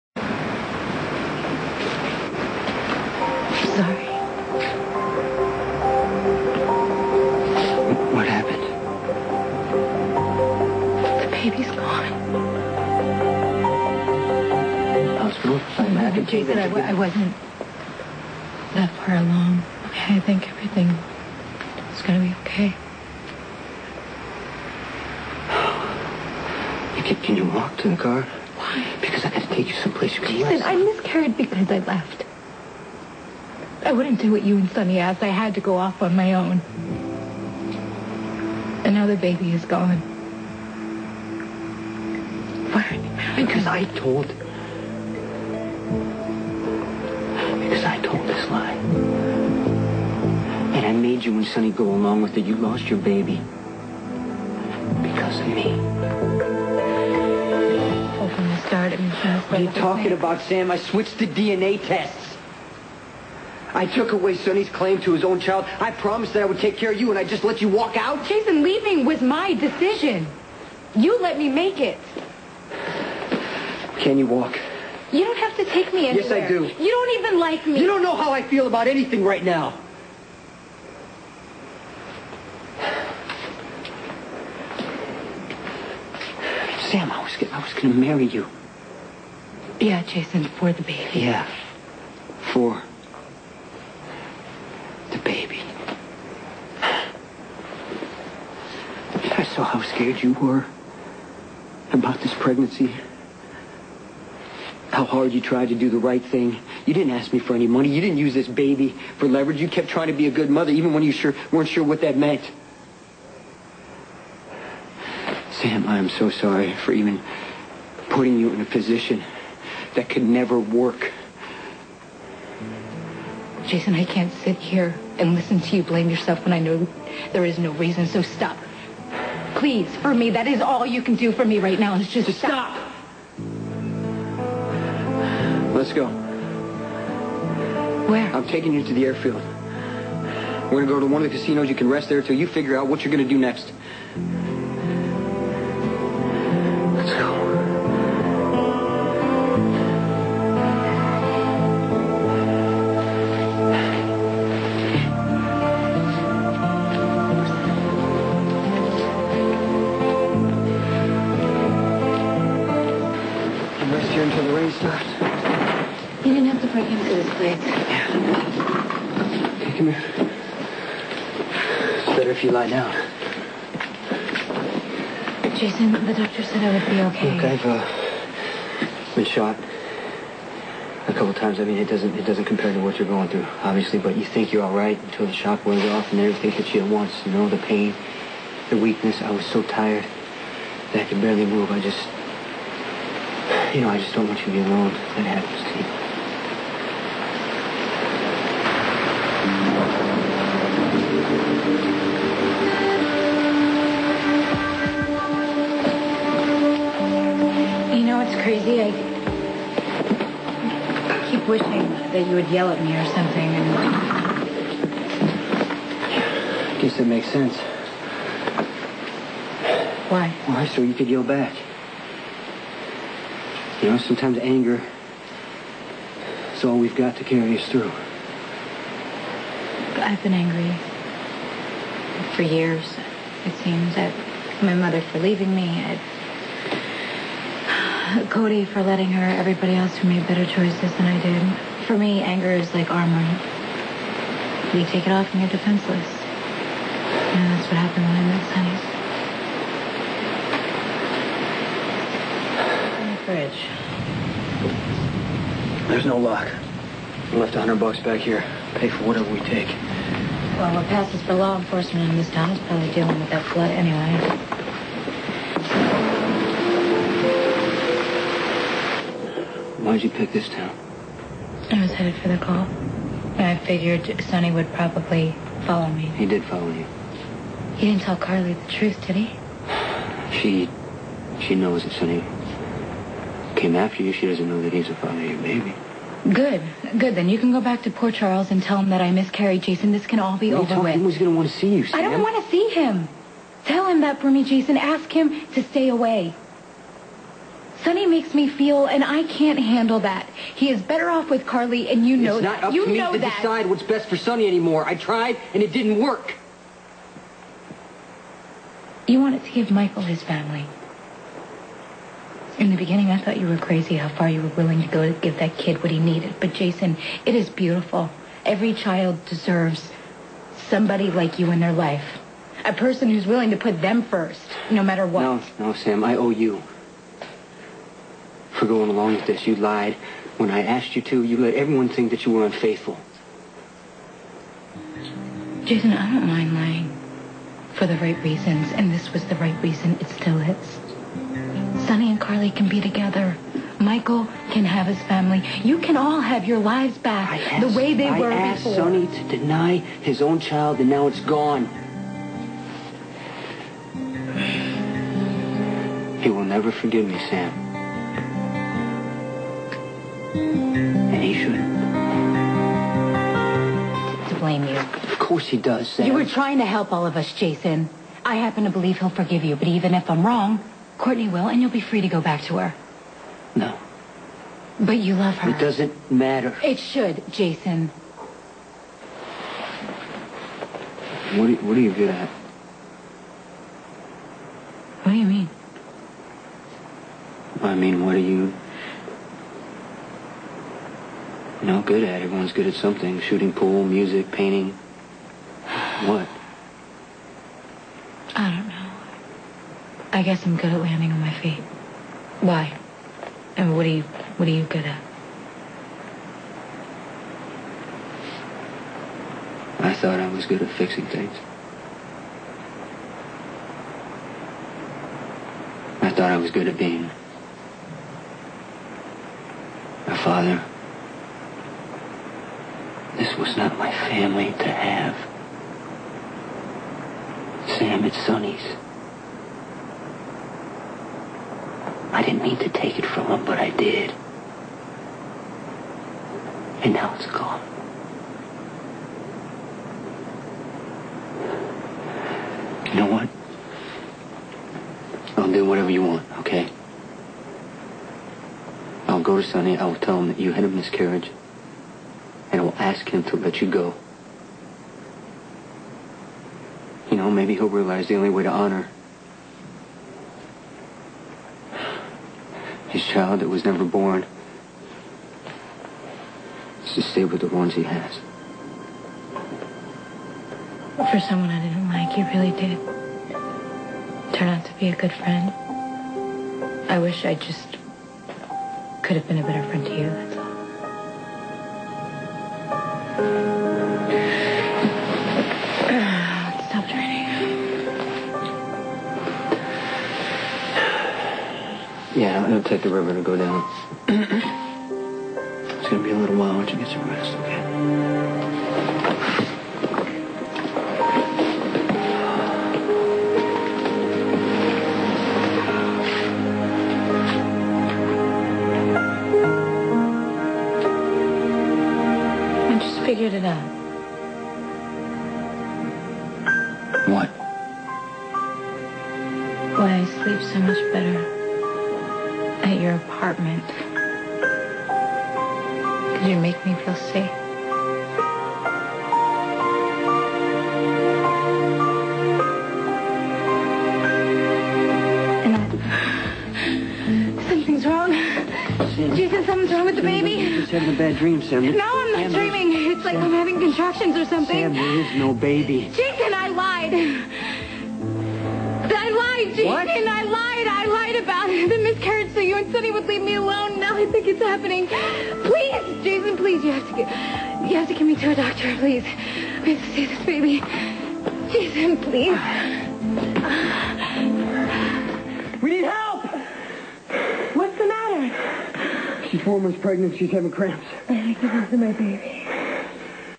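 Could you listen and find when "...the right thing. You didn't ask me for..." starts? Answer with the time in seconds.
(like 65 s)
105 s.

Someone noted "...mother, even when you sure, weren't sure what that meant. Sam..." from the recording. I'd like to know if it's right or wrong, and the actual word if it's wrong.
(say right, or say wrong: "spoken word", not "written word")
right.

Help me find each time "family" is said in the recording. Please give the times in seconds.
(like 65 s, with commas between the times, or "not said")
310 s, 345 s, 423 s.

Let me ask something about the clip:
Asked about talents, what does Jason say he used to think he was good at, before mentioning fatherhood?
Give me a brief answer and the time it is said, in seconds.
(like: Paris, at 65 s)
fixing things, at 410 s.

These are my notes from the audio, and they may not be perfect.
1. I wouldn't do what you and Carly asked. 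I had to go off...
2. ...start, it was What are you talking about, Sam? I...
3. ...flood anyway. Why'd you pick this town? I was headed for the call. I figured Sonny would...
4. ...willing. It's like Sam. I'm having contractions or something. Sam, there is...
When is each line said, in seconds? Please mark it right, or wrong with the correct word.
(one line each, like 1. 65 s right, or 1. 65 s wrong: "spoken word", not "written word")
1. 33 s wrong: "Sonny", not "Carly"
2. 58 s right
3. 263 s right
4. 542 s wrong: "dreaming", not "willing".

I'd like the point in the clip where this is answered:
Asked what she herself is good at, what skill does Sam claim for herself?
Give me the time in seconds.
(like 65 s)
400 s.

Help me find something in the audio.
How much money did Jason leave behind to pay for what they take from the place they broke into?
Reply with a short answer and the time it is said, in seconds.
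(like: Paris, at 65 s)
$100, at 257 s.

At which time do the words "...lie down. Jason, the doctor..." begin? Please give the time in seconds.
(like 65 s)
172 s.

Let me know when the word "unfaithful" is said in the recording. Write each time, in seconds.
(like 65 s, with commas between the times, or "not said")
332 s.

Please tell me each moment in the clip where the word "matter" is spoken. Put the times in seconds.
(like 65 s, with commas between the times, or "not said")
324 s, 376 s, 567 s.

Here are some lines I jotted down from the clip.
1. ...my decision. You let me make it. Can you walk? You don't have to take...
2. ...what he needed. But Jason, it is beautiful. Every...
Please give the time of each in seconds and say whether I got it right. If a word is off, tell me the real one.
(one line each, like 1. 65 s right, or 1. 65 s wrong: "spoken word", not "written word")
1. 69 s right
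2. 315 s right.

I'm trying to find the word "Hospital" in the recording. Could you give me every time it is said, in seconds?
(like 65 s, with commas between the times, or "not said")
15 s.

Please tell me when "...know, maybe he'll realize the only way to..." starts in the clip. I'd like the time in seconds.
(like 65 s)
457 s.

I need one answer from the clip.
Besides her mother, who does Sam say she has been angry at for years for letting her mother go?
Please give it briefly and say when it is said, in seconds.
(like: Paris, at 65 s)
Cody, at 238 s.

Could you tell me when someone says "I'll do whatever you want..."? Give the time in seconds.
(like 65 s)
445 s.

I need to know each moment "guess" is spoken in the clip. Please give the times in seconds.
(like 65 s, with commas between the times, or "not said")
216 s, 400 s.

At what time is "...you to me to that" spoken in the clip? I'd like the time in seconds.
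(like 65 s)
302 s.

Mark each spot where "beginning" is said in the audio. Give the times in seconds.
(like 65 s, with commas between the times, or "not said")
312 s.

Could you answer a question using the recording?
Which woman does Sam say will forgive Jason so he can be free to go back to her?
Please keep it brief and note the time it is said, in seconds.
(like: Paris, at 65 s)
Courtney, at 370 s.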